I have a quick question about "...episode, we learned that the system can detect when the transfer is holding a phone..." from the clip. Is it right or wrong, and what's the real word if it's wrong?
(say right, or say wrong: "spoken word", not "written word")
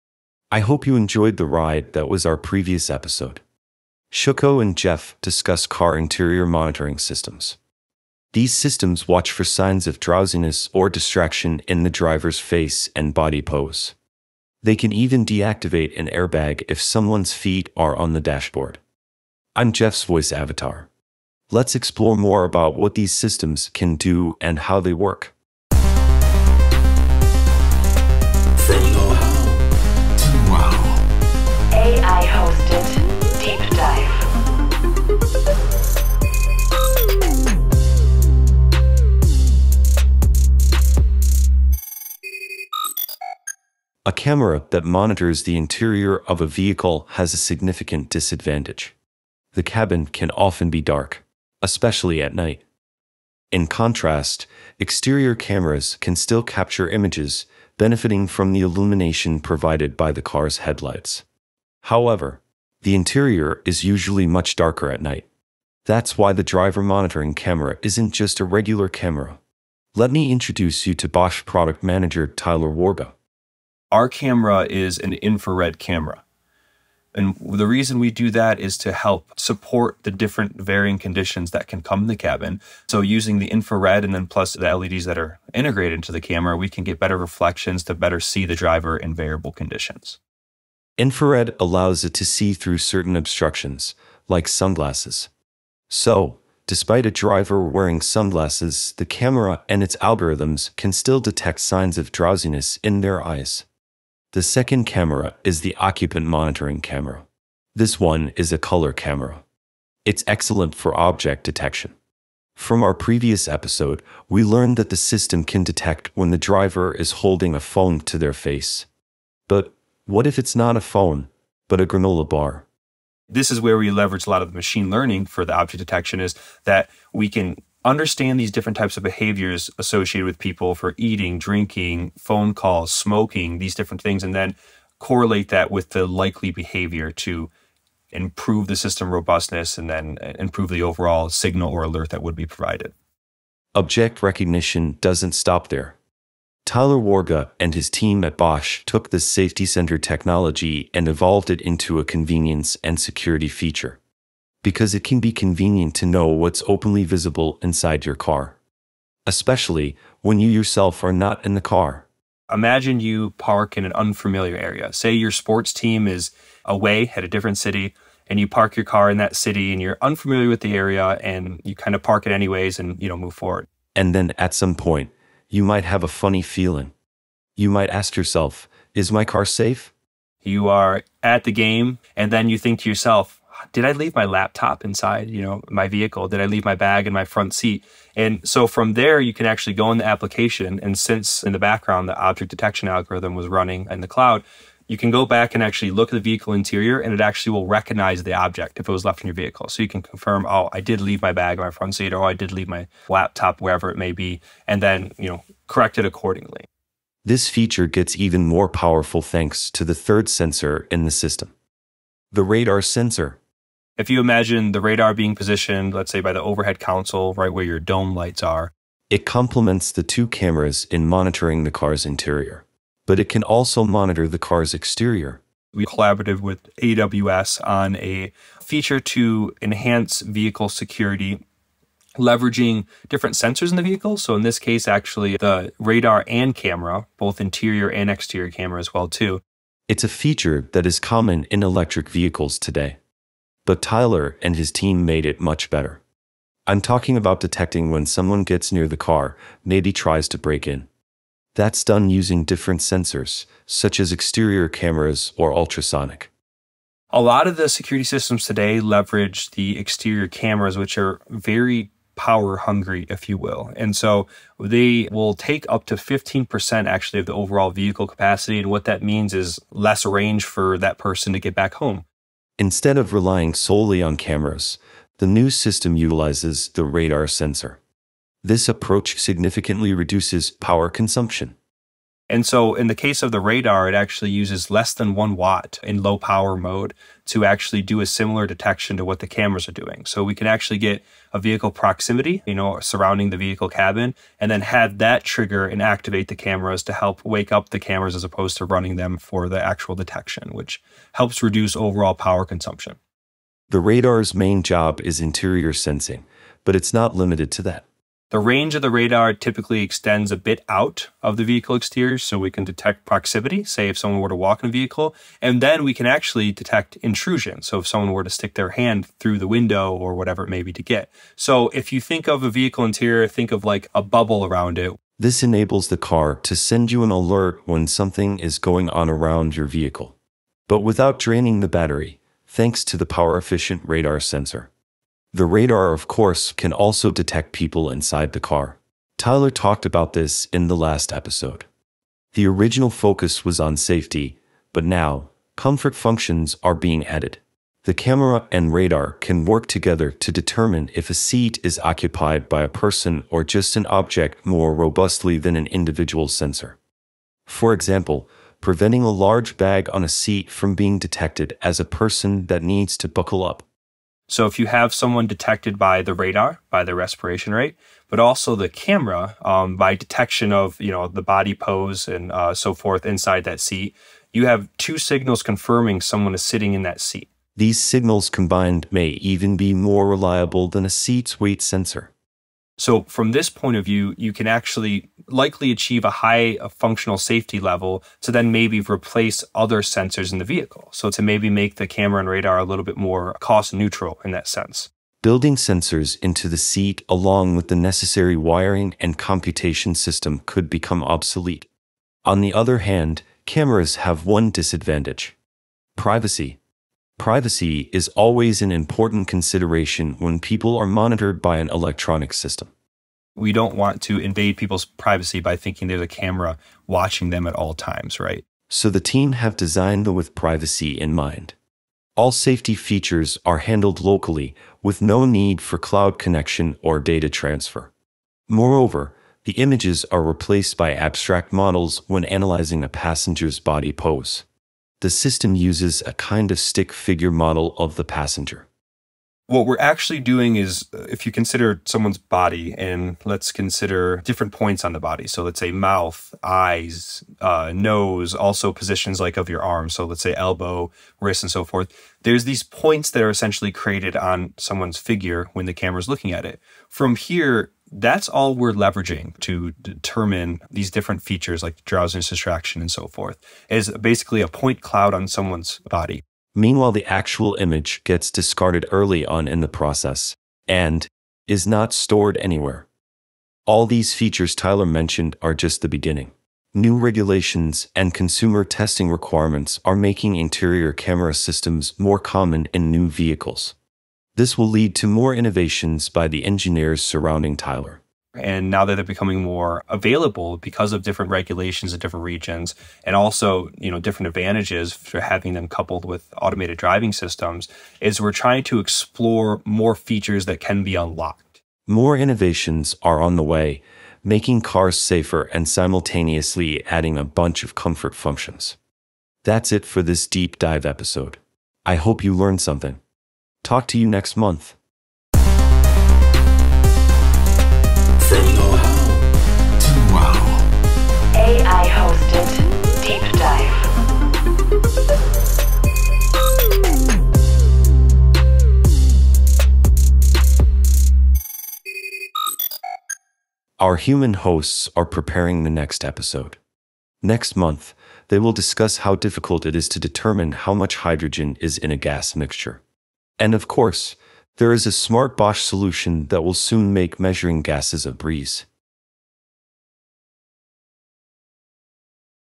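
wrong: "driver", not "transfer".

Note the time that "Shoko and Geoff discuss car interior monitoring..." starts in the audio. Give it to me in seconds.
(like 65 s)
4 s.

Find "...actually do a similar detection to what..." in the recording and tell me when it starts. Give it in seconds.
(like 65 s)
287 s.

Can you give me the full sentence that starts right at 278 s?
This approach significantly reduces power consumption.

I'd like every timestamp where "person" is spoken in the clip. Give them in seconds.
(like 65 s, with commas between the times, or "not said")
270 s, 352 s, 361 s.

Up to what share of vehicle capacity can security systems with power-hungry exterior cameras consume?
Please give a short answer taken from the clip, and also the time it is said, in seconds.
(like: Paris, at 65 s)
15%, at 265 s.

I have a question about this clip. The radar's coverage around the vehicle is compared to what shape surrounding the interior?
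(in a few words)
A bubble.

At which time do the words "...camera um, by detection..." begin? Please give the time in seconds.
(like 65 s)
368 s.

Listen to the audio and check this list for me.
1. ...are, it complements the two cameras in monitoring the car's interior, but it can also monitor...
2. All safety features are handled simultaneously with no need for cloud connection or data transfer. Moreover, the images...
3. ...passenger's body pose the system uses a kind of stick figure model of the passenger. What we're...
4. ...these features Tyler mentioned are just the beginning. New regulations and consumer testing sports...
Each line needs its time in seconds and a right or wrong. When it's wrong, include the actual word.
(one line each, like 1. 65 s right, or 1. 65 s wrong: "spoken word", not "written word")
1. 218 s right
2. 422 s wrong: "locally", not "simultaneously"
3. 432 s right
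4. 473 s wrong: "requirements", not "sports".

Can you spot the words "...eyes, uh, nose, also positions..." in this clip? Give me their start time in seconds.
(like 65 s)
446 s.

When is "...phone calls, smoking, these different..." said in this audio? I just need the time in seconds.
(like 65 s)
132 s.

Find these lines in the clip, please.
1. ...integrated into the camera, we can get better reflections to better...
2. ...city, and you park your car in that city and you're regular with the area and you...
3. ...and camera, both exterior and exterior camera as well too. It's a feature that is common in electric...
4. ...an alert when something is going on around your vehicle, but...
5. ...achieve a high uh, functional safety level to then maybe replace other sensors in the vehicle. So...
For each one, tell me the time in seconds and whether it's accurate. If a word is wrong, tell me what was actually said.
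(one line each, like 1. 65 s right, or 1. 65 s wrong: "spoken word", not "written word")
1. 85 s right
2. 167 s wrong: "unfamiliar", not "regular"
3. 236 s wrong: "interior", not "exterior"
4. 327 s right
5. 385 s right.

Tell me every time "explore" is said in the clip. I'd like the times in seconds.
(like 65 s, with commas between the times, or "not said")
21 s, 498 s.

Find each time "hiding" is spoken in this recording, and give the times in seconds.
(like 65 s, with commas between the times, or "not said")
not said.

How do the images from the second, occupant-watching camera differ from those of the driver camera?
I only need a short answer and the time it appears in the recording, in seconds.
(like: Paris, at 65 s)
Color camera, at 108 s.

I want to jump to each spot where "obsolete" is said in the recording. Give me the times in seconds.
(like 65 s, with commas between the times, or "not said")
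401 s.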